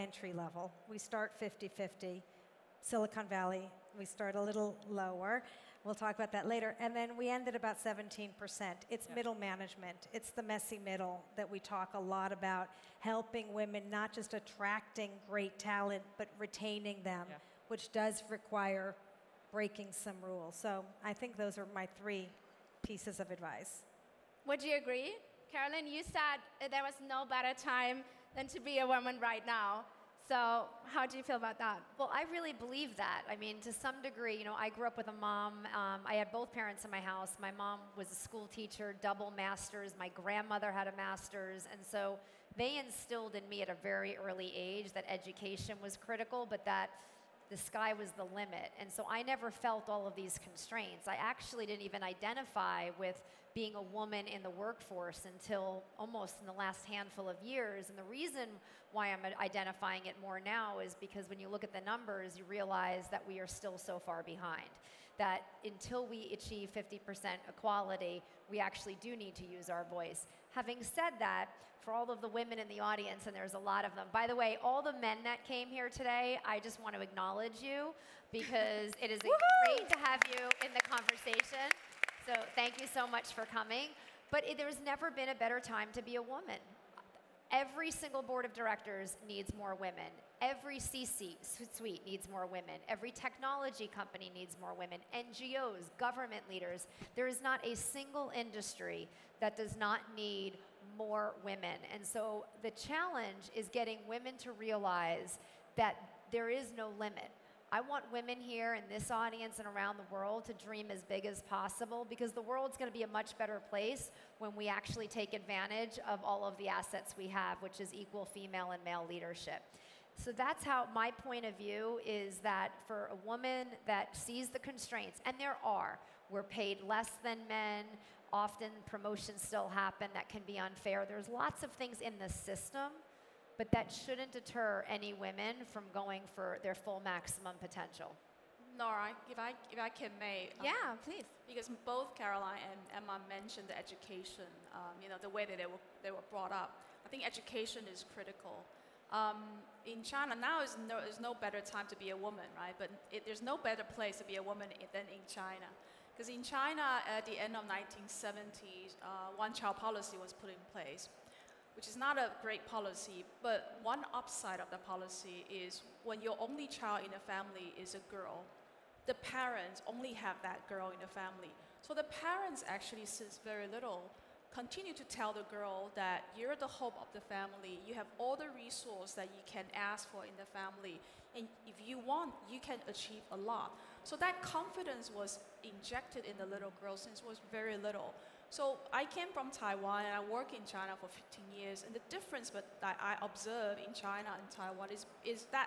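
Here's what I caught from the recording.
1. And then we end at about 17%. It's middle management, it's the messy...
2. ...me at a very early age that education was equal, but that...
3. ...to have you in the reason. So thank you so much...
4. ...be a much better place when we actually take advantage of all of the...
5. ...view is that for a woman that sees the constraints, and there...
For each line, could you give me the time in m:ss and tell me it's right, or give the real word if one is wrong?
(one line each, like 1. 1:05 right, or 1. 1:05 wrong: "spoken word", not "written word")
1. 0:06 right
2. 0:43 wrong: "critical", not "equal"
3. 1:19 wrong: "conversation", not "reason"
4. 1:52 right
5. 2:01 right.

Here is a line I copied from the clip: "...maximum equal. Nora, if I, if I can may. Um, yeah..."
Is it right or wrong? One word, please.
wrong.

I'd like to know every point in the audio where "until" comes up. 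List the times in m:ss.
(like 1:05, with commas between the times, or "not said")
0:55, 1:05.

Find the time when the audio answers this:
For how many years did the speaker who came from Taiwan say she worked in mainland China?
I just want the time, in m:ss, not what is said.
3:11.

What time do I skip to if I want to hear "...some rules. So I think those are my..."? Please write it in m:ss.
0:19.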